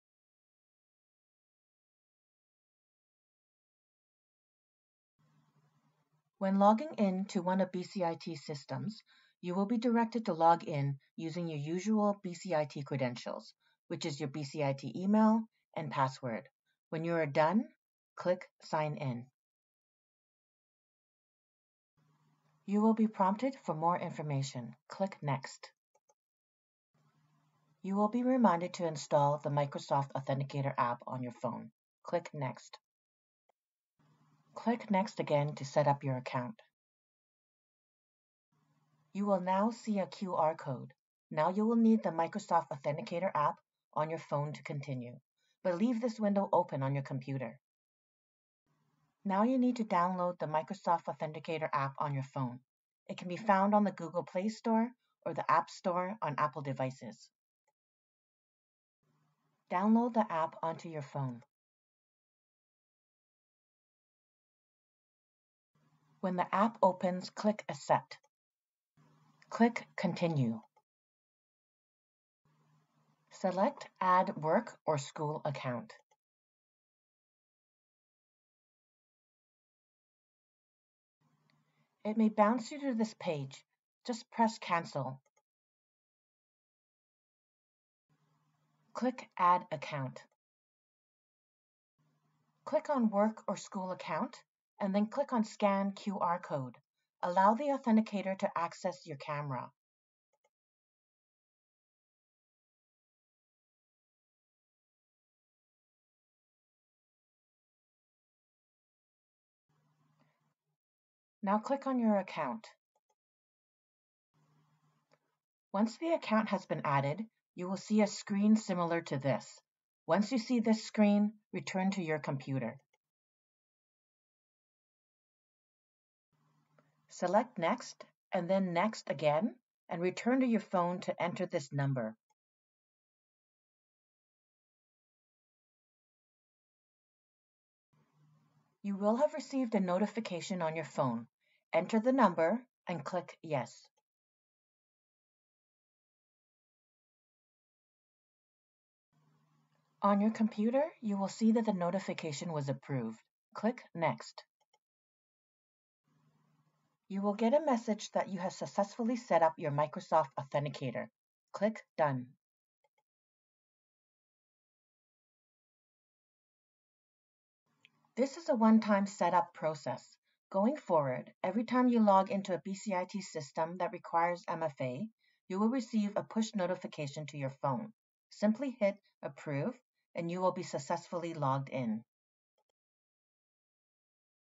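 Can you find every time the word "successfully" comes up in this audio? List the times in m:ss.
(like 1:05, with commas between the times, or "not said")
2:38, 3:00.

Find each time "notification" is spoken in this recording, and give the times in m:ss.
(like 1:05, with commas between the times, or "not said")
2:19, 2:31, 2:56.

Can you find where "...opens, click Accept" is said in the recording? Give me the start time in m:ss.
1:06.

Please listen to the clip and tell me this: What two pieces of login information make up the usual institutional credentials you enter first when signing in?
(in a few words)
BCIT email and password.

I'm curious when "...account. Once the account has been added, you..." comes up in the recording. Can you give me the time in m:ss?
1:52.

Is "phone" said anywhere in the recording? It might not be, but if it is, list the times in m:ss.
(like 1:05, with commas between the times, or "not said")
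0:31, 0:44, 0:52, 1:01, 2:10, 2:20, 2:57.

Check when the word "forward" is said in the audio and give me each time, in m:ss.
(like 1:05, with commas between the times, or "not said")
2:50.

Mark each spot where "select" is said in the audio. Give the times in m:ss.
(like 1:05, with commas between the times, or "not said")
1:13, 2:07.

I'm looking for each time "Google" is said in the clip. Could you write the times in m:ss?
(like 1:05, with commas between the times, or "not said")
0:53.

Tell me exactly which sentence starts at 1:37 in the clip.
Allow the authenticator to access your camera.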